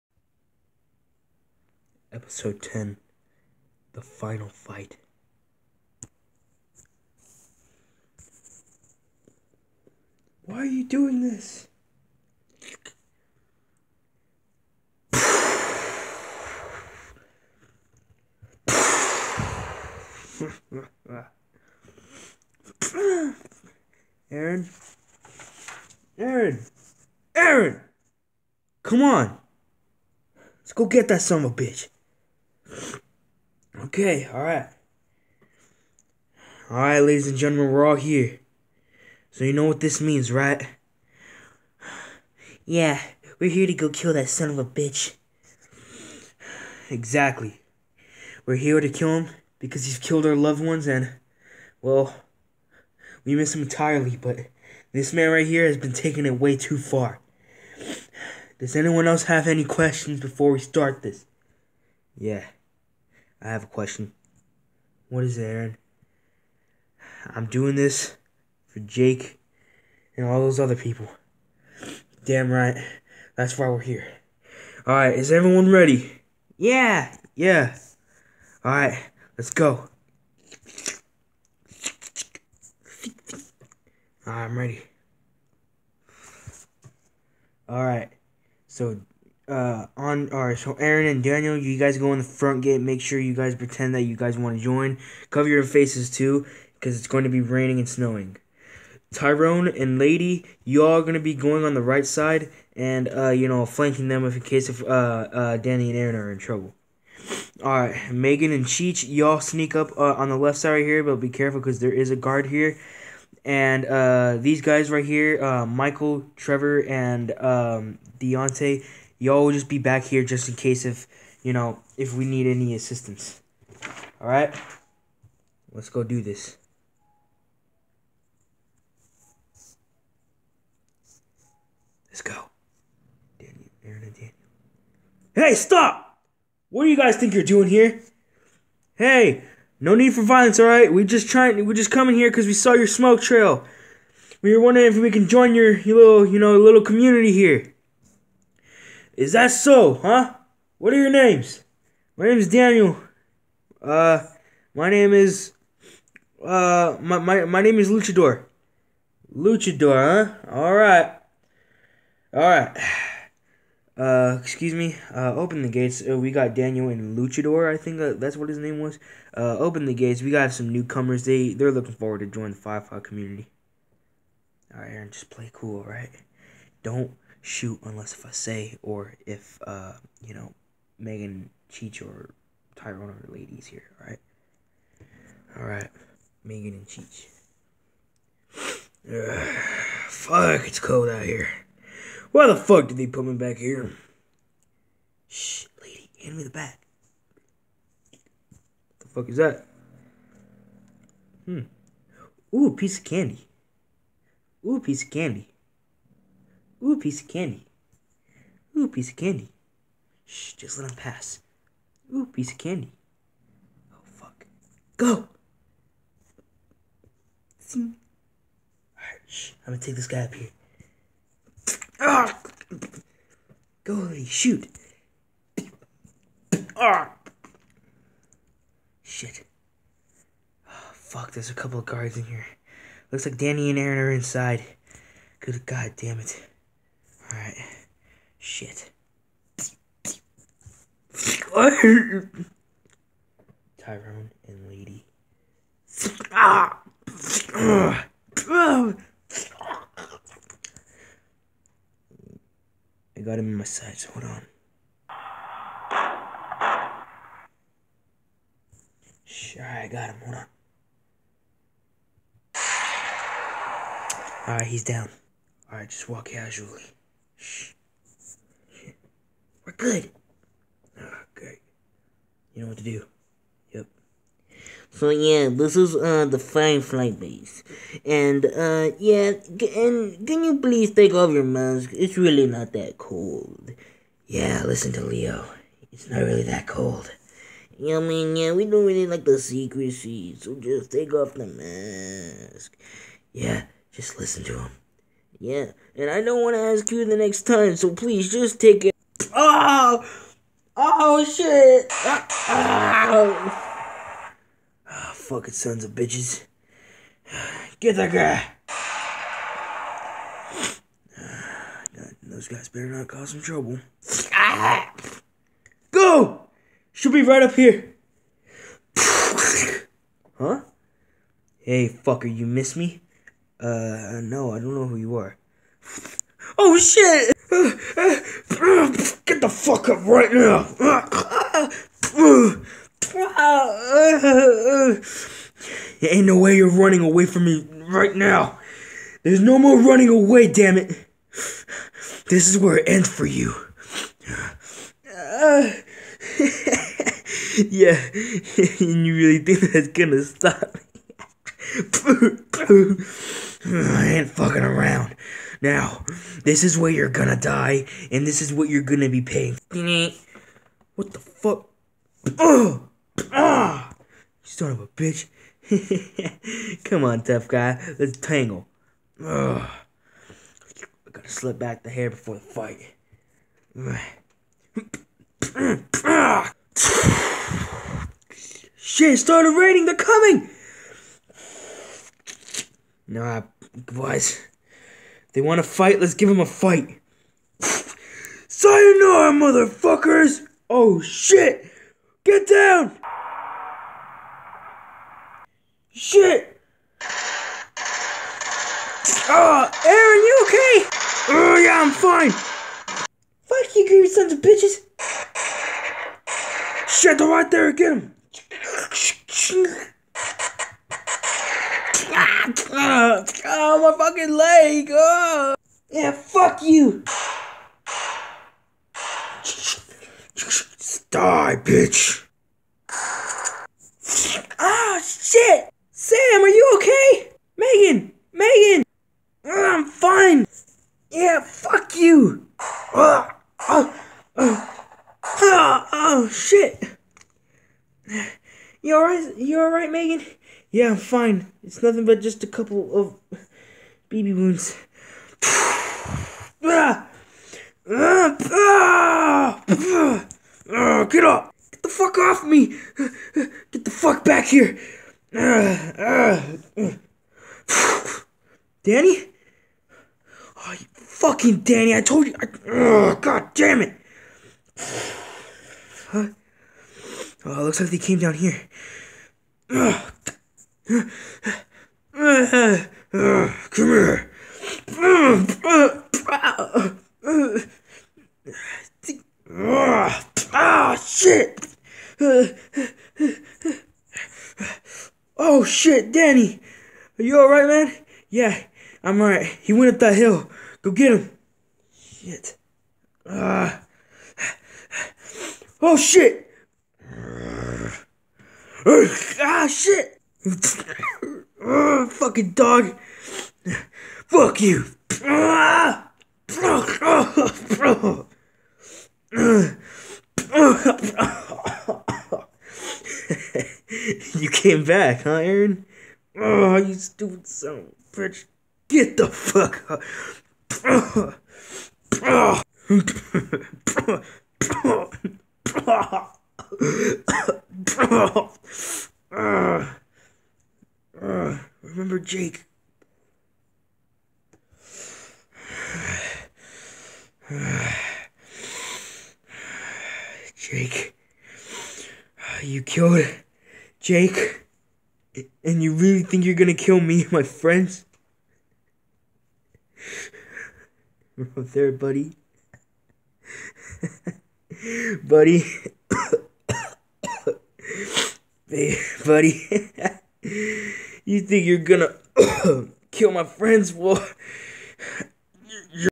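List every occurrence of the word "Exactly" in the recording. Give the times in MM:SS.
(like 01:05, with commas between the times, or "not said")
00:46.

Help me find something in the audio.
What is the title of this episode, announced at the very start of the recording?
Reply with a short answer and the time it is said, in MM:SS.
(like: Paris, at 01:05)
The Final Fight, at 00:03.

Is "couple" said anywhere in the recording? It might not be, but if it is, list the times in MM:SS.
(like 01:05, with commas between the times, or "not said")
03:51, 07:22.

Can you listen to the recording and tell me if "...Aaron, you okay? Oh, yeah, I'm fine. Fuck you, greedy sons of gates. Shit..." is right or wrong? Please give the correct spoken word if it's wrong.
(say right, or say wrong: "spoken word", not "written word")
wrong: "bitches", not "gates".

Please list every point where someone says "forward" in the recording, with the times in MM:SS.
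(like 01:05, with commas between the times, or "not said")
02:51.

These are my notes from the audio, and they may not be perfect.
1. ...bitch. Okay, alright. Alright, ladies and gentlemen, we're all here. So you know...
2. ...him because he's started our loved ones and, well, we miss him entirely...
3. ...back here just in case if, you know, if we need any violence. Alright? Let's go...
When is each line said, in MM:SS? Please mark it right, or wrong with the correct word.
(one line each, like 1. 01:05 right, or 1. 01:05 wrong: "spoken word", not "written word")
1. 00:31 right
2. 00:49 wrong: "killed", not "started"
3. 01:59 wrong: "assistance", not "violence".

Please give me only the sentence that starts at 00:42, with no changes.
Yeah, we're here to go kill that son of a bitch.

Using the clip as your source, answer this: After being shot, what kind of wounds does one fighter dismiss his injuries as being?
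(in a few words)
BB wounds.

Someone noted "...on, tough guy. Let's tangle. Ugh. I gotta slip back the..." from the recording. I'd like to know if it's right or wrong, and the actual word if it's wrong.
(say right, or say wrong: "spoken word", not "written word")
right.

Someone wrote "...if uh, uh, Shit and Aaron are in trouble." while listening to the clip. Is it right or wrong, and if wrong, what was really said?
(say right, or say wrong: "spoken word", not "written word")
wrong: "Danny", not "Shit".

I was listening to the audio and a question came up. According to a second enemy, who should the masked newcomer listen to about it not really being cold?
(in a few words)
Leo.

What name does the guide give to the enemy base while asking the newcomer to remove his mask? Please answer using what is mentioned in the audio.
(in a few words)
Firefly base.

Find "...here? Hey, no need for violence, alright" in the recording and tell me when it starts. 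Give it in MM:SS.
02:17.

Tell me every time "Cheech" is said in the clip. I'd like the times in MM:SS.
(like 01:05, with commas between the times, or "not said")
01:48, 03:01, 03:06.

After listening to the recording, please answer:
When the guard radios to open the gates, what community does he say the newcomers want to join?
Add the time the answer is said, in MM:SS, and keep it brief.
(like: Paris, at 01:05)
Five Five community, at 02:52.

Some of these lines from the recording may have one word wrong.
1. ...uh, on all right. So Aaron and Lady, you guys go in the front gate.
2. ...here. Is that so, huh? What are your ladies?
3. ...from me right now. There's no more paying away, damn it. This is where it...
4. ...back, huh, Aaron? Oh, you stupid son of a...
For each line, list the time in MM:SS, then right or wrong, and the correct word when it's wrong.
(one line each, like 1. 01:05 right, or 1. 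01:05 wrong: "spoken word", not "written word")
1. 01:29 wrong: "Daniel", not "Lady"
2. 02:27 wrong: "names", not "ladies"
3. 05:37 wrong: "running", not "paying"
4. 08:34 right.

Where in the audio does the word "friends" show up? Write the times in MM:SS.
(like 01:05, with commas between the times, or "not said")
09:07, 09:23.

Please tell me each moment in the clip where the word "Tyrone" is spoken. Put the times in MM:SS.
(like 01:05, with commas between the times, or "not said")
01:39, 03:02, 04:03.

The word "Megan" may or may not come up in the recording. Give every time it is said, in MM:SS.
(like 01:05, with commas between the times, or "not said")
01:48, 03:00, 03:06.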